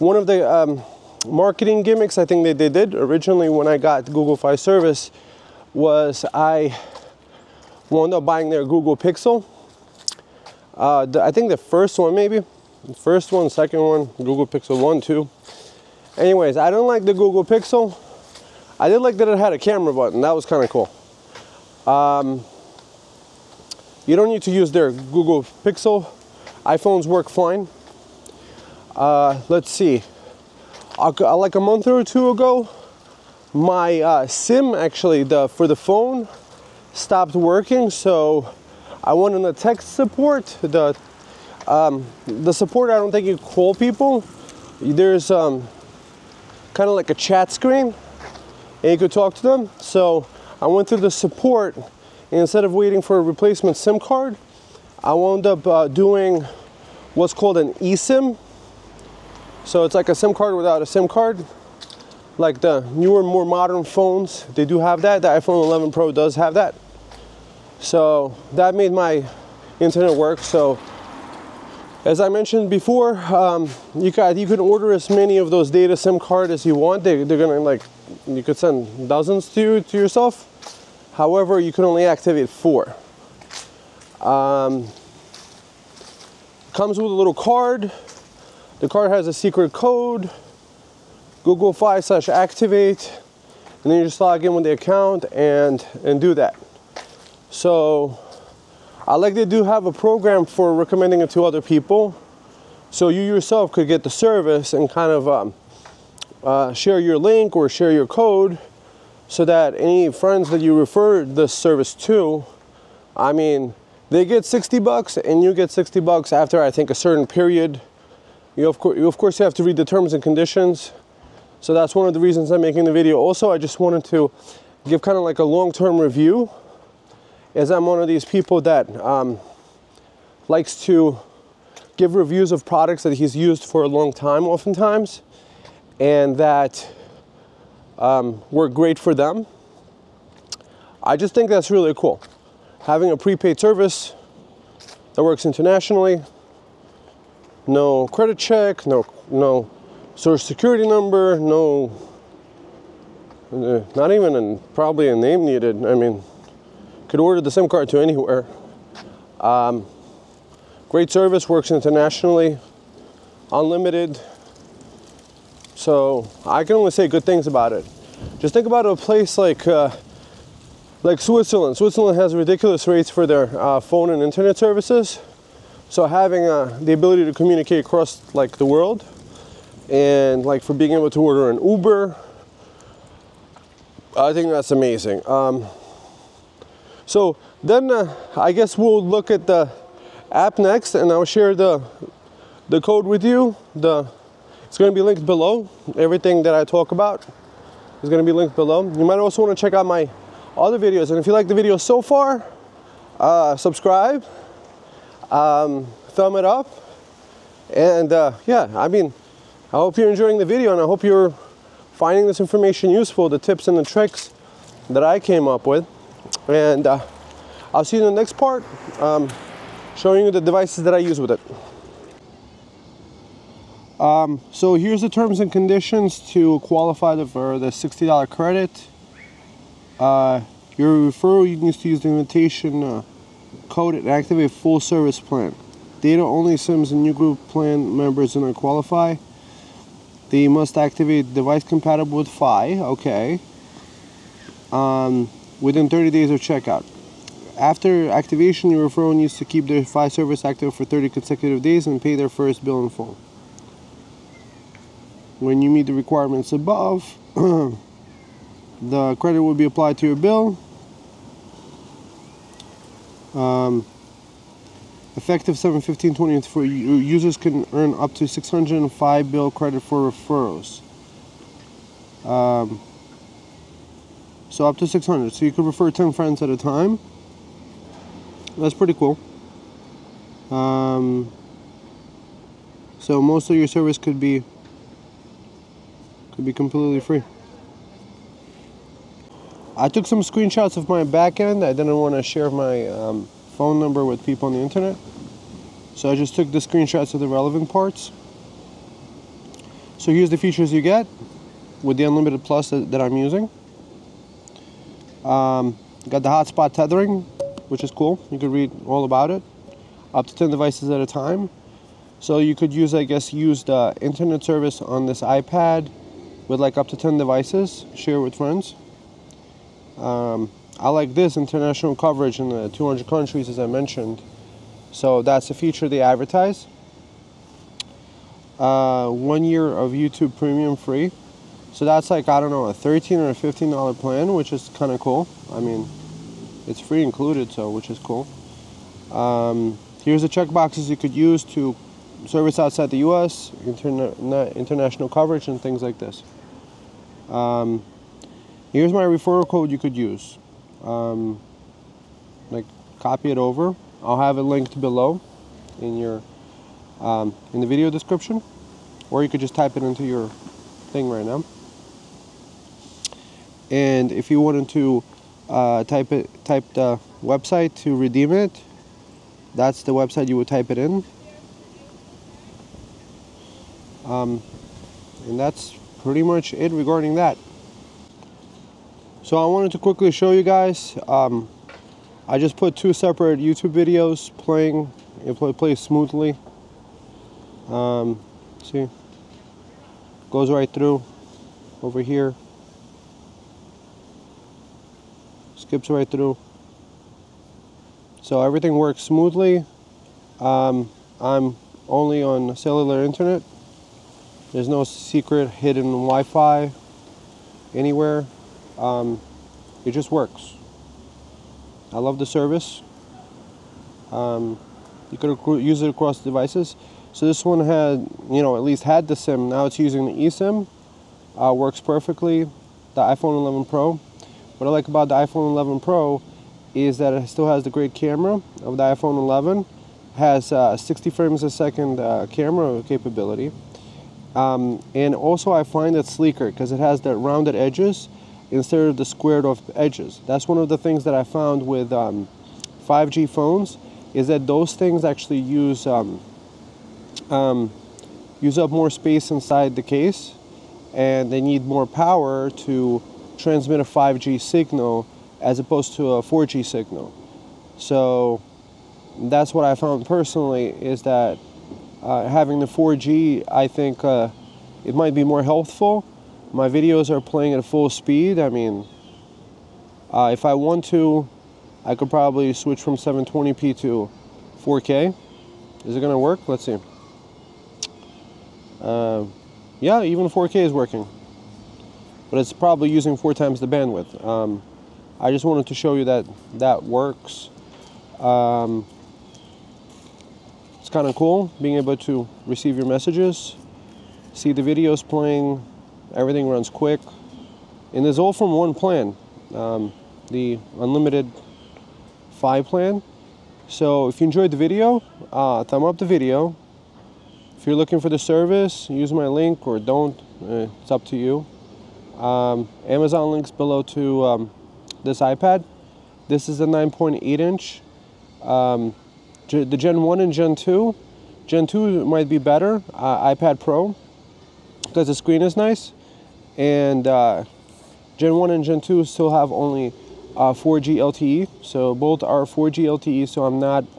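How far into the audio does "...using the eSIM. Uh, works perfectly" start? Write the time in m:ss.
6:59.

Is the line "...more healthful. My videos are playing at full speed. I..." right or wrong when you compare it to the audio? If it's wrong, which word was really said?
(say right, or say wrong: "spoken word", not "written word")
right.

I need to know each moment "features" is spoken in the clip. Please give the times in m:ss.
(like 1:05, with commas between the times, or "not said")
5:00, 5:25.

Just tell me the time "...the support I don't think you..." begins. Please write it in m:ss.
0:42.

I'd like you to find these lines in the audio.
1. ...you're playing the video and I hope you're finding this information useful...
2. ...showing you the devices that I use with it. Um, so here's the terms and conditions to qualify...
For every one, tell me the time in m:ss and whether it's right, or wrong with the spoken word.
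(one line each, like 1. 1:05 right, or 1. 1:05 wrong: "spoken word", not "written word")
1. 3:29 wrong: "enjoying", not "playing"
2. 3:39 right.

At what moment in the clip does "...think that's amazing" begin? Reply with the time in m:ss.
3:04.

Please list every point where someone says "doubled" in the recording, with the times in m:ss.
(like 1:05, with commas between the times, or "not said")
not said.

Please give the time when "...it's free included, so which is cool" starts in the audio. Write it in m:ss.
5:36.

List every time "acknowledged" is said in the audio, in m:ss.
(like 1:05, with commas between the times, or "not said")
not said.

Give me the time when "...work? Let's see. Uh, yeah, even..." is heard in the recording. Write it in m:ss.
7:56.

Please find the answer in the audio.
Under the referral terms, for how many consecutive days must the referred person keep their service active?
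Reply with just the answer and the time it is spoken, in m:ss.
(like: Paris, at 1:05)
30, at 4:10.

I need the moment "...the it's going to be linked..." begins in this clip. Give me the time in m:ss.
3:13.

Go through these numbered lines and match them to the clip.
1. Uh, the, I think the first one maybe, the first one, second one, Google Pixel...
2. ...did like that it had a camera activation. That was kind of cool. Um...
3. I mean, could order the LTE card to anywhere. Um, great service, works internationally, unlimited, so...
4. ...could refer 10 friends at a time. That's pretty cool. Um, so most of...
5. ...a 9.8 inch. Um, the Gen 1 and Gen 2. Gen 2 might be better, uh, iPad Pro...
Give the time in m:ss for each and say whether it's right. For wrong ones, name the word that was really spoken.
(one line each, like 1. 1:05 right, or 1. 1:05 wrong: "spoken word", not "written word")
1. 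0:10 right
2. 0:18 wrong: "button", not "activation"
3. 2:35 wrong: "SIM", not "LTE"
4. 4:35 right
5. 8:36 right.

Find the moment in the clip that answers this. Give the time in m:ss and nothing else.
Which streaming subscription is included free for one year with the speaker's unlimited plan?
5:29.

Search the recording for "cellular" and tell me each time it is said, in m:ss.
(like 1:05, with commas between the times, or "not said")
6:42.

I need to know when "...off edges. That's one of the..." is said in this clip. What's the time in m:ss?
7:19.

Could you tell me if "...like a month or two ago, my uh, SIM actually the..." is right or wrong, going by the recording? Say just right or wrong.
right.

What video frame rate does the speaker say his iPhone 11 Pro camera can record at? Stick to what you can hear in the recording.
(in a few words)
60 frames per second.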